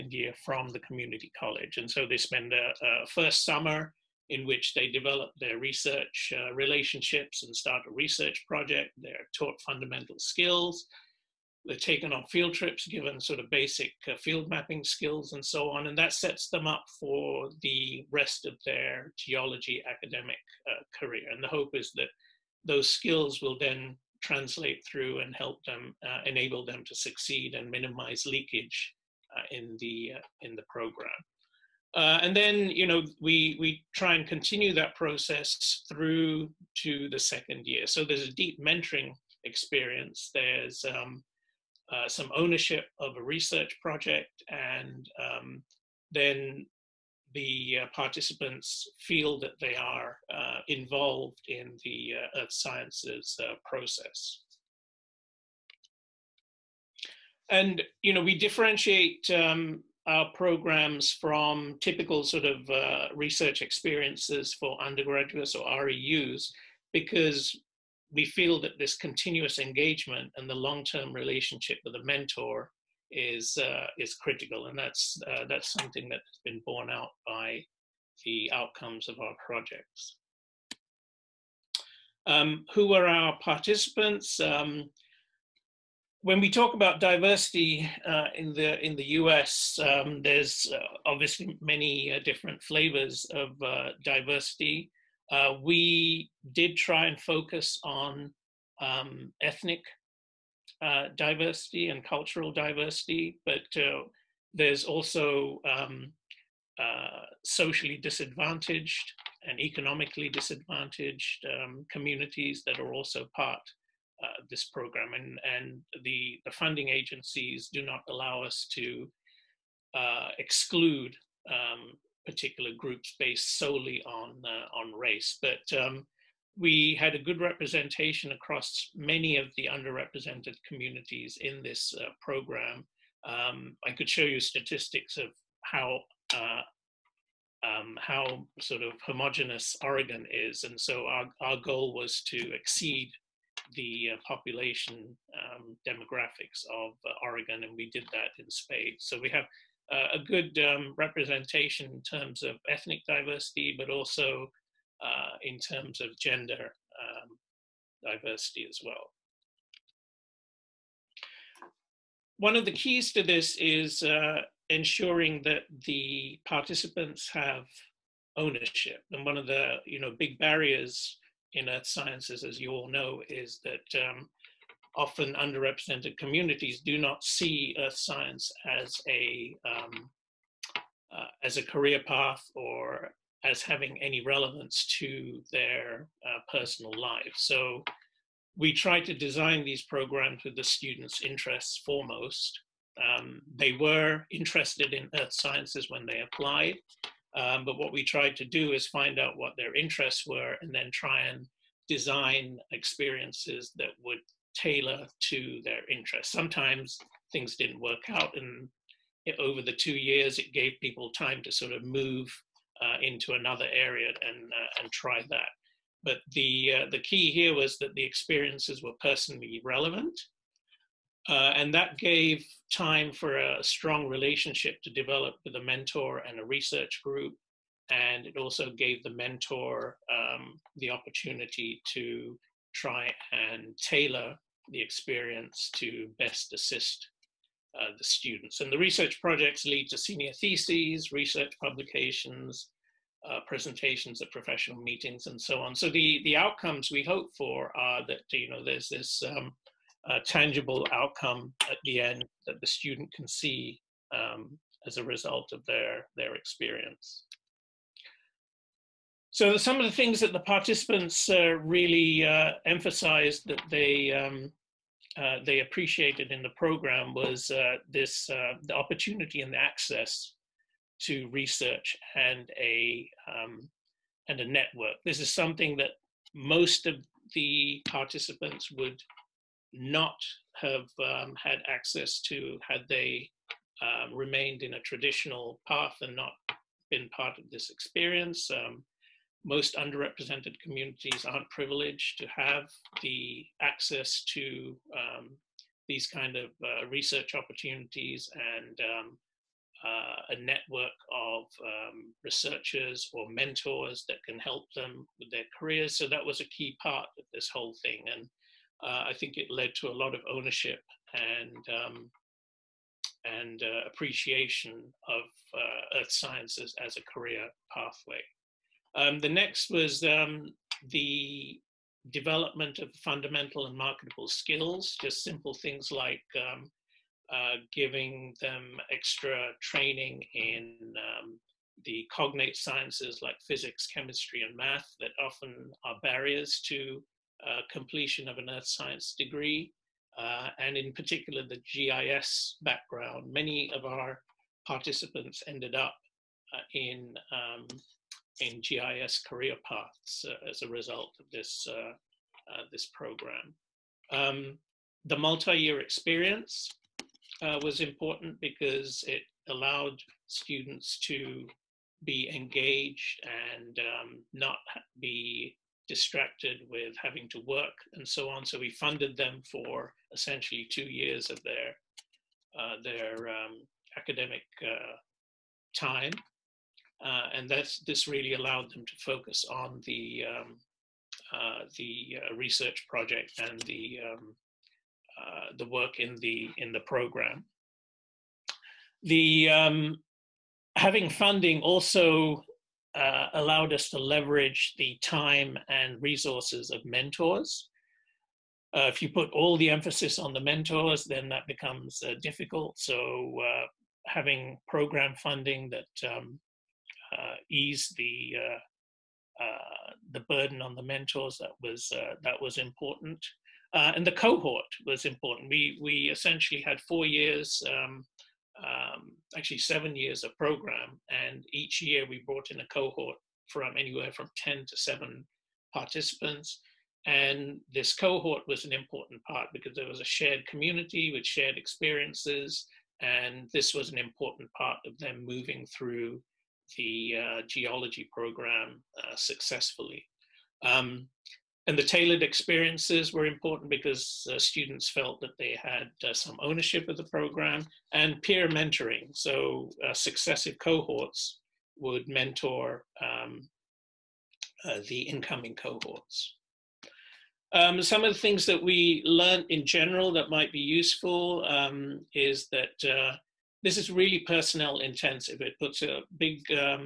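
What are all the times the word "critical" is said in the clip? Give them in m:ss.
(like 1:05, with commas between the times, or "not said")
1:14.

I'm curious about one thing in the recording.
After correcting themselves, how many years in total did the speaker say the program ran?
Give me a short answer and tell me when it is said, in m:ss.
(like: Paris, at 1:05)
7, at 6:59.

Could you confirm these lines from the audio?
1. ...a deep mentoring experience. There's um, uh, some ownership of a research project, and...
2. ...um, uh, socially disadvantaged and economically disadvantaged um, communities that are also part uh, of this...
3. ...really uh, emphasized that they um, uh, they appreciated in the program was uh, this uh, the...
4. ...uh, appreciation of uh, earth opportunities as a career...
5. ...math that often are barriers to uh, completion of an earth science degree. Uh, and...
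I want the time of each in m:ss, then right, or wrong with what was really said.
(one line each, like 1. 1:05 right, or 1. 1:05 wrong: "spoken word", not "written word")
1. 0:38 right
2. 1:45 right
3. 4:21 right
4. 5:13 wrong: "sciences", not "opportunities"
5. 5:34 right.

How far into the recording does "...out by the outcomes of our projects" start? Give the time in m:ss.
1:16.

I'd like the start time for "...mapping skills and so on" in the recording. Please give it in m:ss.
0:14.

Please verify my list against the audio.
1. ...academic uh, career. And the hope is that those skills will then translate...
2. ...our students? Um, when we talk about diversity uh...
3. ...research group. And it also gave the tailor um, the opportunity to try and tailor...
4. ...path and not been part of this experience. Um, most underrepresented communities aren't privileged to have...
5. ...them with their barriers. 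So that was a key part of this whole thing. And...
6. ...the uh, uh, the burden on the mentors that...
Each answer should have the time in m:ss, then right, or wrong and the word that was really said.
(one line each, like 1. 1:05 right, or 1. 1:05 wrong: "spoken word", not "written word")
1. 0:19 right
2. 1:23 wrong: "participants", not "students"
3. 3:46 wrong: "mentor", not "tailor"
4. 4:45 right
5. 5:04 wrong: "careers", not "barriers"
6. 6:47 right.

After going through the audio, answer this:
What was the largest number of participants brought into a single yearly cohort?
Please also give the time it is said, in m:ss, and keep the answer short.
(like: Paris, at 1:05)
10, at 7:04.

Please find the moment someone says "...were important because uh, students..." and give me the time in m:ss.
7:23.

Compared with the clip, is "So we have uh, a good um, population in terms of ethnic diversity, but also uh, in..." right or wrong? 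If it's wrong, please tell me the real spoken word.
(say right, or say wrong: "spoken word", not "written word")
wrong: "representation", not "population".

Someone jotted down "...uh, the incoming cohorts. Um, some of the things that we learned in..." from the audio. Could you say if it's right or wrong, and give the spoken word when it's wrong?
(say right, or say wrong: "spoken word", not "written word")
right.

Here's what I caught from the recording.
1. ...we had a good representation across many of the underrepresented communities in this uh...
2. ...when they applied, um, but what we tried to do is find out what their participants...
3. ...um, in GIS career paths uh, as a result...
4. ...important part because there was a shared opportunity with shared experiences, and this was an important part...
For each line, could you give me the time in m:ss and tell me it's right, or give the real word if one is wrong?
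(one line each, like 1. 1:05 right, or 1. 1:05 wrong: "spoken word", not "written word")
1. 2:06 right
2. 3:15 wrong: "interests", not "participants"
3. 5:47 right
4. 7:08 wrong: "community", not "opportunity".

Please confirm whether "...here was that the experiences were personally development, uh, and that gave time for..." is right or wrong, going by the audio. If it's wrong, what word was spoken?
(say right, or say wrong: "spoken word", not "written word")
wrong: "relevant", not "development".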